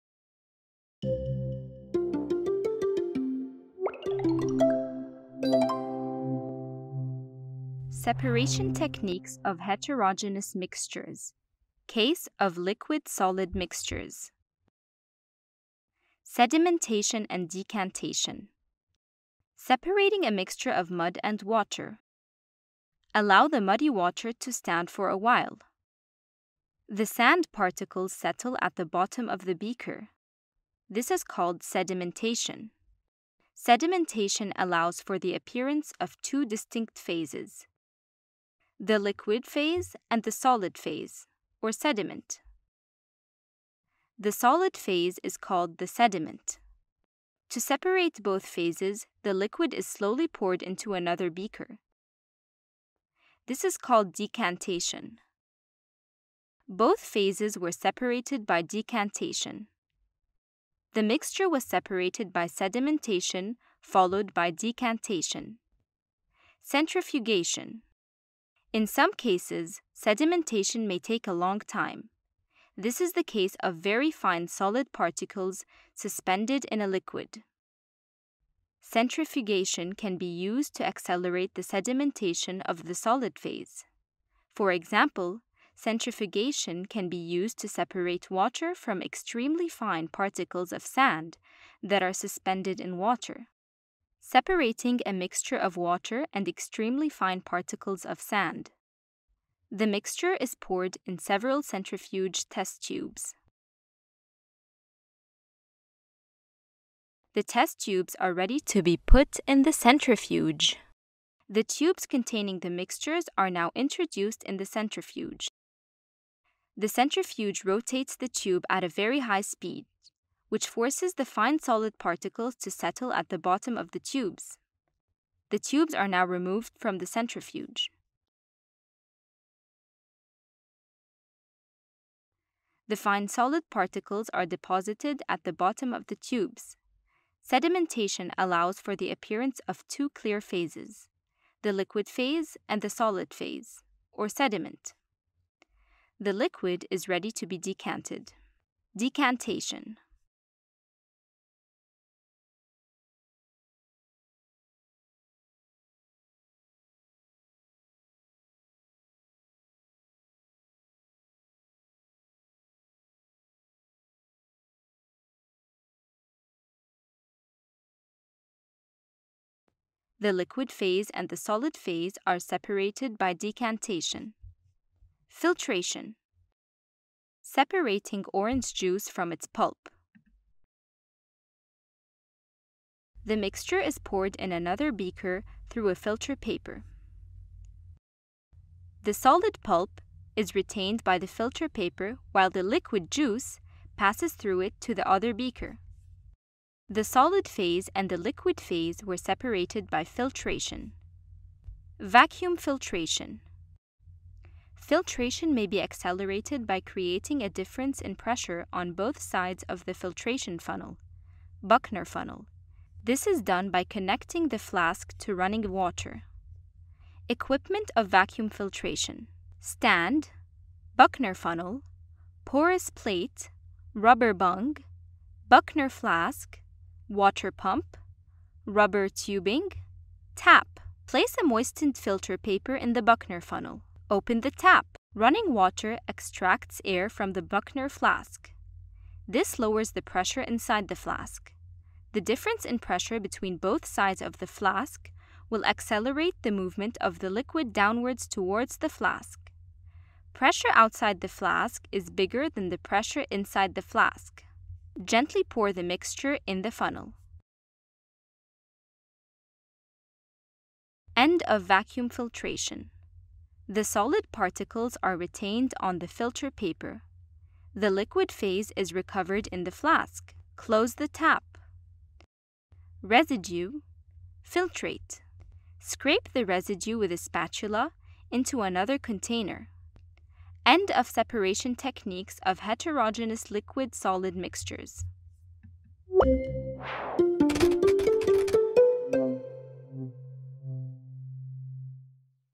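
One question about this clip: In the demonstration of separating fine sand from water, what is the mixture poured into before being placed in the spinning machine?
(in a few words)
Centrifuge test tubes.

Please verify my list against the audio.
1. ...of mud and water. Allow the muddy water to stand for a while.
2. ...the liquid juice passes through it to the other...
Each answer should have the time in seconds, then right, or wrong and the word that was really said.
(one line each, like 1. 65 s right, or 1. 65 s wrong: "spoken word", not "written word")
1. 20 s right
2. 192 s right.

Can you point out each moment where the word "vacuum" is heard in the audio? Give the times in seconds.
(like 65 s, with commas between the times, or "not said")
202 s, 218 s, 261 s.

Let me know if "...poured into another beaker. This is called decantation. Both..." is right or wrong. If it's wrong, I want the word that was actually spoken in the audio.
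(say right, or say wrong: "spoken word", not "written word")
right.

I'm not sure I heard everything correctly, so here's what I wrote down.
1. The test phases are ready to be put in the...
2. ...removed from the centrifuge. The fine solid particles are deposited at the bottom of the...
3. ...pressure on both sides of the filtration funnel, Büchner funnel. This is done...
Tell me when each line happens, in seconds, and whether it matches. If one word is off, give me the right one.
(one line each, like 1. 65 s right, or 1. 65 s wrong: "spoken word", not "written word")
1. 107 s wrong: "tubes", not "phases"
2. 126 s right
3. 208 s right.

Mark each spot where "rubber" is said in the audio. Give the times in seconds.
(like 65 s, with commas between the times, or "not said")
223 s, 228 s.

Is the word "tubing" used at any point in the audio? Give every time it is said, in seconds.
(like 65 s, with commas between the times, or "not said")
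229 s.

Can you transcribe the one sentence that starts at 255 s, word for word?
Gently pour the mixture in the funnel.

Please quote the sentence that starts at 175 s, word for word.
Filtration Separating orange juice from its pulp.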